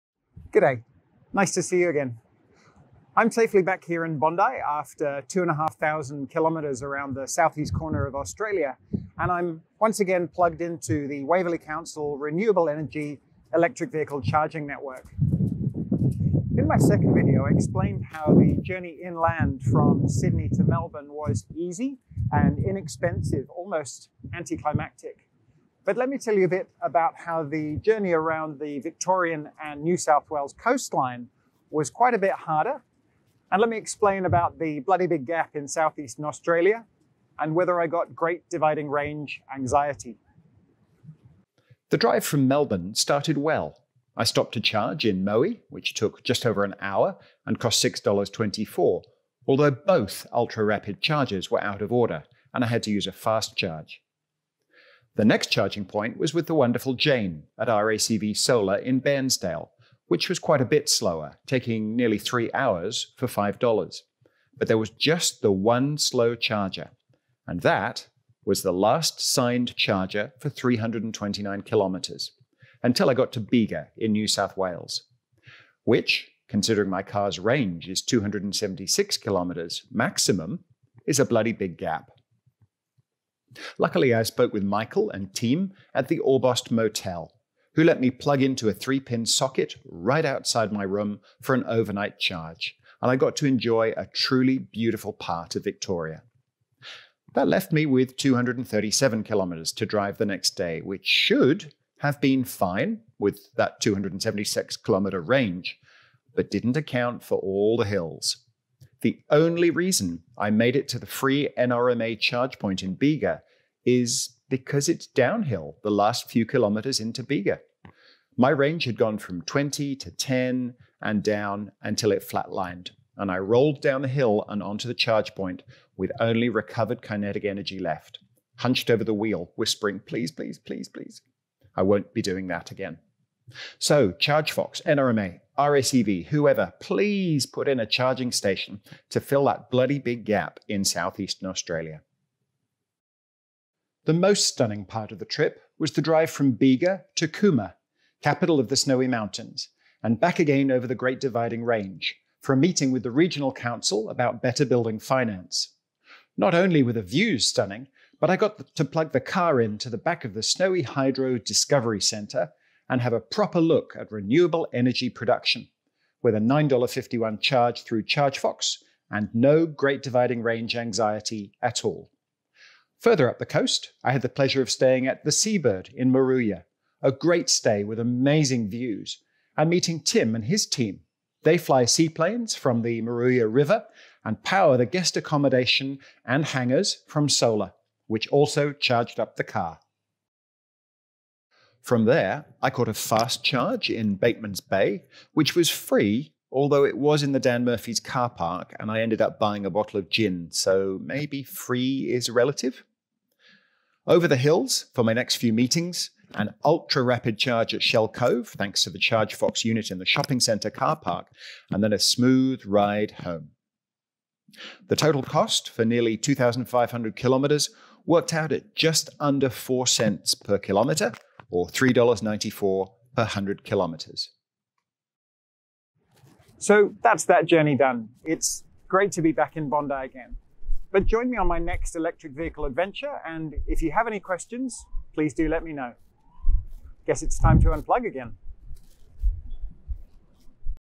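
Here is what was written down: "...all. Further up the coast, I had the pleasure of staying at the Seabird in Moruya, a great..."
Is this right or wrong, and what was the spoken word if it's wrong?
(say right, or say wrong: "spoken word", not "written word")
right.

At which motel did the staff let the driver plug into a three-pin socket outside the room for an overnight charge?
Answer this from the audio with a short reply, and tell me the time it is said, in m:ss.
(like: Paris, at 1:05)
Orbost Motel, at 1:26.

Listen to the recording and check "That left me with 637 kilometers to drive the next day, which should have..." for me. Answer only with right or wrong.
wrong.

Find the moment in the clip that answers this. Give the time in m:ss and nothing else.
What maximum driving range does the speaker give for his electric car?
1:18.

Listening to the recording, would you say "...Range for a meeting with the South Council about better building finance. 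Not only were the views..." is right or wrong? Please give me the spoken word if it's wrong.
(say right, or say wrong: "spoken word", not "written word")
wrong: "Regional", not "South".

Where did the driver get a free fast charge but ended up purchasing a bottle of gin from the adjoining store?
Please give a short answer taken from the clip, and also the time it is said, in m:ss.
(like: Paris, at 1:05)
Bateman's Bay, at 3:14.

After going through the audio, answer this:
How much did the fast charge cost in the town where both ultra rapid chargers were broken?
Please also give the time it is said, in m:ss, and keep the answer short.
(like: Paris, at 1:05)
$6.24, at 0:47.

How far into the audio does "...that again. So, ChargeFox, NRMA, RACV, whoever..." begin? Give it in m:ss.
2:12.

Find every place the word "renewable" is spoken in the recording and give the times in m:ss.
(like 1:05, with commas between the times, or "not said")
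0:12, 2:44.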